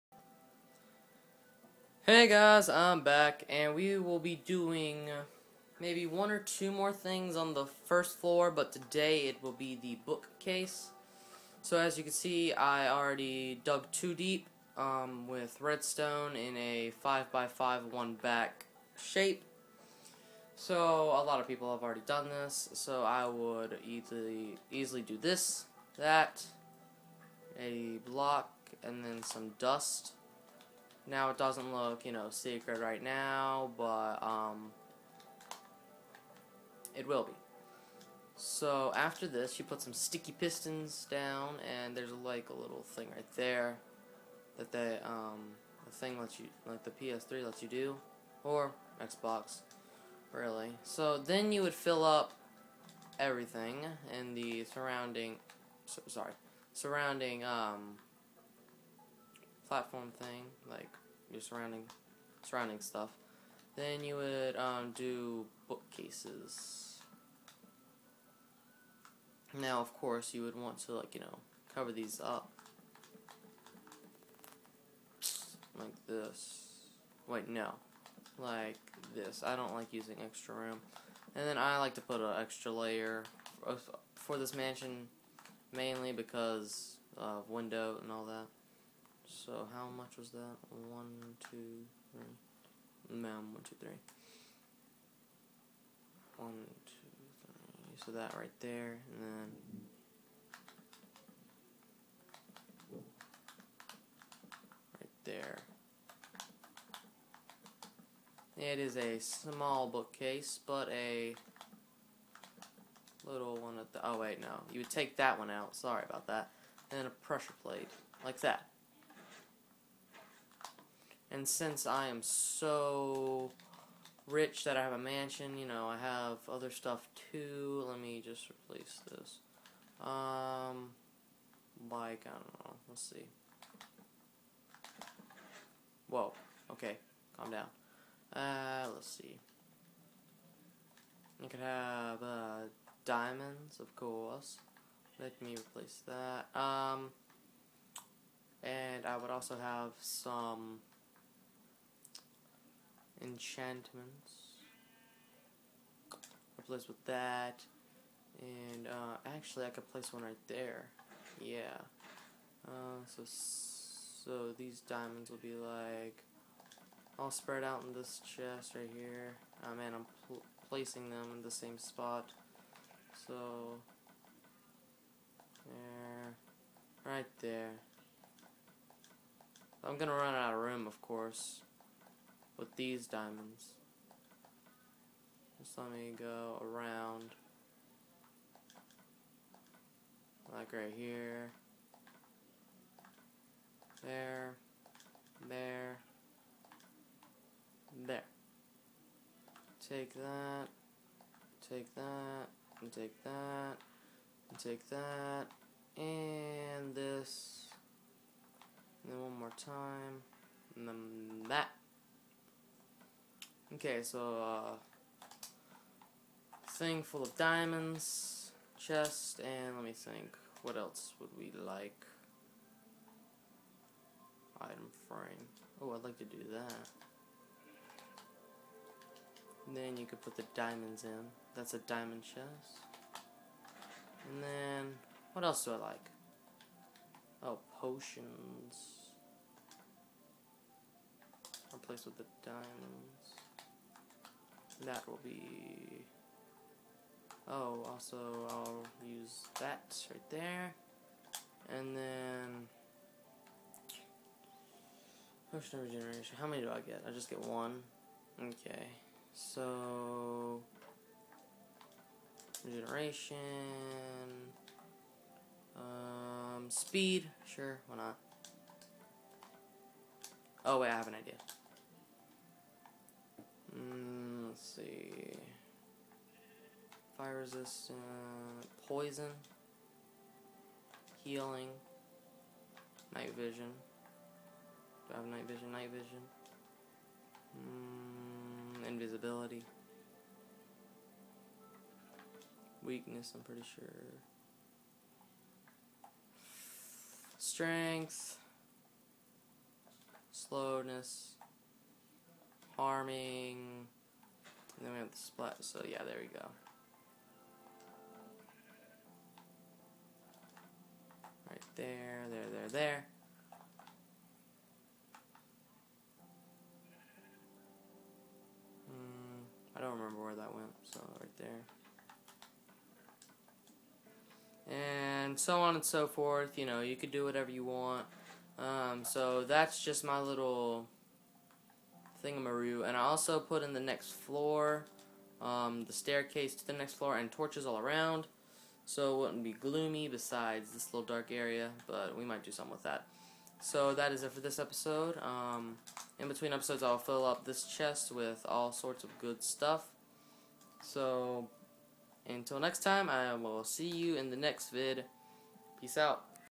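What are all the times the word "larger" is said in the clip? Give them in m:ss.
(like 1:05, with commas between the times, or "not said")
not said.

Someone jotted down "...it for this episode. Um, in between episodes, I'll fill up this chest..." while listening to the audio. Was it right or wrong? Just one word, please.
right.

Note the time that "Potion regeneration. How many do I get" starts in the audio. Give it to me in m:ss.
4:15.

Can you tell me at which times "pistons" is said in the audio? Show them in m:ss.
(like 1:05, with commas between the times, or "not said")
0:40.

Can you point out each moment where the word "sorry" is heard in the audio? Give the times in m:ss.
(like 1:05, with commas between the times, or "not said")
0:56, 1:55.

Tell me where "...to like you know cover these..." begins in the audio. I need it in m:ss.
1:10.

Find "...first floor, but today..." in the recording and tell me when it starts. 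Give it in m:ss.
0:07.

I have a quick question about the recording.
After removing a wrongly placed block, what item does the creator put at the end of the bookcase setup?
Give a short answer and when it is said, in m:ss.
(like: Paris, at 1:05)
pressure plate, at 1:57.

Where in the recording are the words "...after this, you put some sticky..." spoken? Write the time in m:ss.
0:38.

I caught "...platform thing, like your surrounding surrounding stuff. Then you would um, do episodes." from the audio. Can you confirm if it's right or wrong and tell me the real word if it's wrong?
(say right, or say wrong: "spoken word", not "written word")
wrong: "bookcases", not "episodes".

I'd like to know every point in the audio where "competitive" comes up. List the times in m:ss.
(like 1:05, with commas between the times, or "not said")
not said.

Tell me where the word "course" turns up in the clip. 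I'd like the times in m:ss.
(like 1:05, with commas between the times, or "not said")
1:09, 2:23, 3:01.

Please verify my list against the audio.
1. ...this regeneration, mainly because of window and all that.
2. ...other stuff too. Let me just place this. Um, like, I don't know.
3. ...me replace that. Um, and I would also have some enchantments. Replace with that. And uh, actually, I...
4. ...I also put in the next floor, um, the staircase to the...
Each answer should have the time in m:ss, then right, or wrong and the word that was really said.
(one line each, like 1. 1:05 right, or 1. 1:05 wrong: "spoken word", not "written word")
1. 1:24 wrong: "mansion", not "regeneration"
2. 2:06 wrong: "replace", not "place"
3. 2:25 right
4. 5:32 right.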